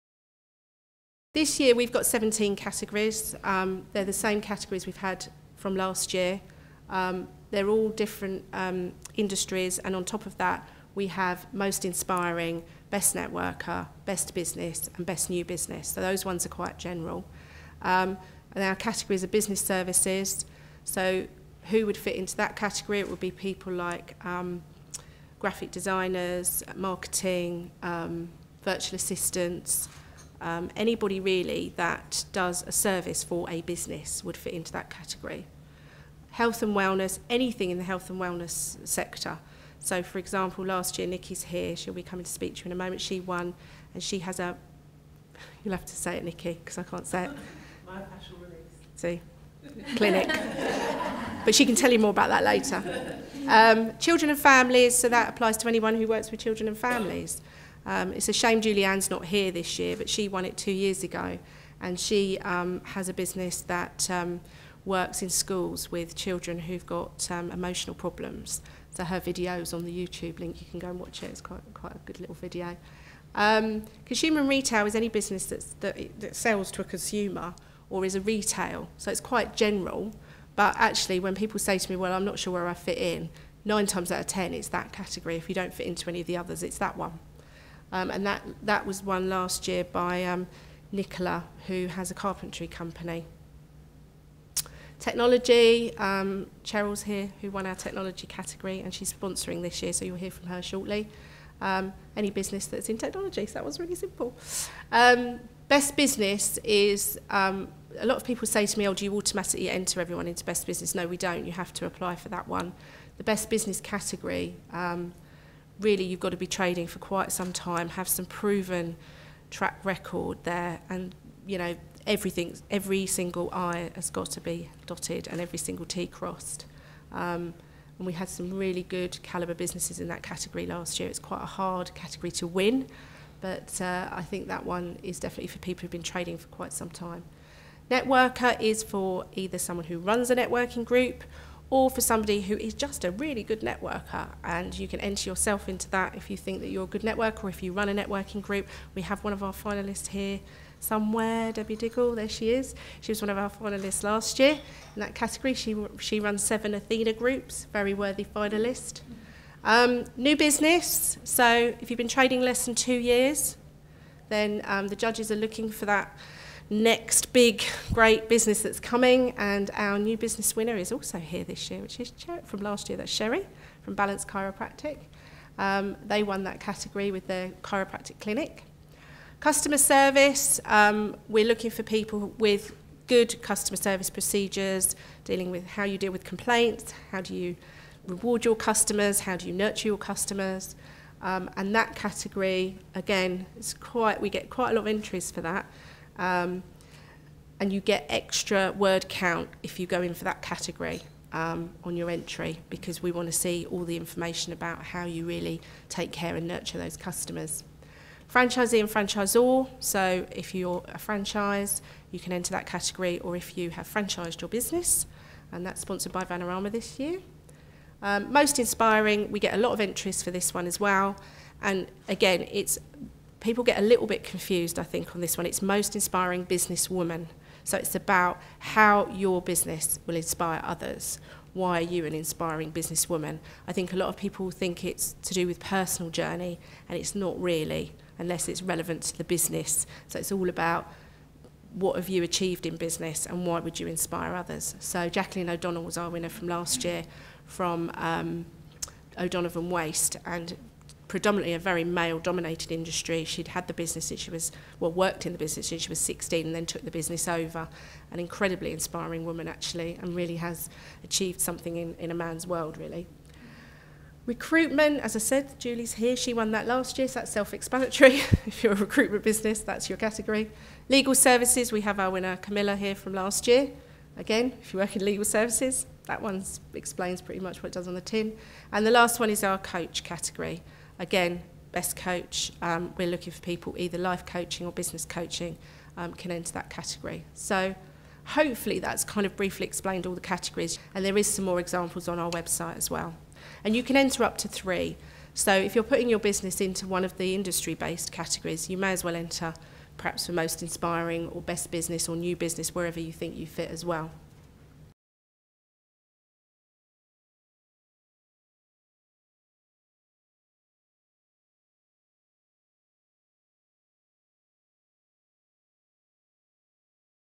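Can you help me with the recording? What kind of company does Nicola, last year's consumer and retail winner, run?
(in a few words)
Carpentry company.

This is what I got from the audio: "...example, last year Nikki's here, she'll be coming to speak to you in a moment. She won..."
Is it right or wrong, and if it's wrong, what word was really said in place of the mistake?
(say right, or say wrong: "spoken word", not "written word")
right.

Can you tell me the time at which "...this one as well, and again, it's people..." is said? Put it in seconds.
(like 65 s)
220 s.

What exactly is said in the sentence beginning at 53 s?
Um, children and families, so that applies to anyone who works with children and families.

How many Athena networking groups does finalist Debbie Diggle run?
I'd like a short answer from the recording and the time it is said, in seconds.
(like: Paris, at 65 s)
7, at 156 s.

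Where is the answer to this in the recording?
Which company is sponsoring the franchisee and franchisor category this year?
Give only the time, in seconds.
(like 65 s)
216 s.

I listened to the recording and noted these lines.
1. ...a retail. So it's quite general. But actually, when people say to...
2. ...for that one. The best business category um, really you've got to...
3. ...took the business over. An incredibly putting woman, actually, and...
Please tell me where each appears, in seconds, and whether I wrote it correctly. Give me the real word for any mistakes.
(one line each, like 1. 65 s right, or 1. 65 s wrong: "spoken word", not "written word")
1. 78 s right
2. 112 s right
3. 256 s wrong: "inspiring", not "putting".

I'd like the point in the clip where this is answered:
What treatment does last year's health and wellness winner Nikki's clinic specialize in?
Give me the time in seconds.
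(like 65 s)
47 s.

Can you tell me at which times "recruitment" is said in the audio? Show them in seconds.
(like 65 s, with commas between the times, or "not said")
264 s, 268 s.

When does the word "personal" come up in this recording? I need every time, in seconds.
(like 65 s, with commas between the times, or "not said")
235 s.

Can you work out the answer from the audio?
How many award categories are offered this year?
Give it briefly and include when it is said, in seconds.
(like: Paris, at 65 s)
17, at 2 s.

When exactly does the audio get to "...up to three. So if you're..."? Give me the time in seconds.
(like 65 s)
294 s.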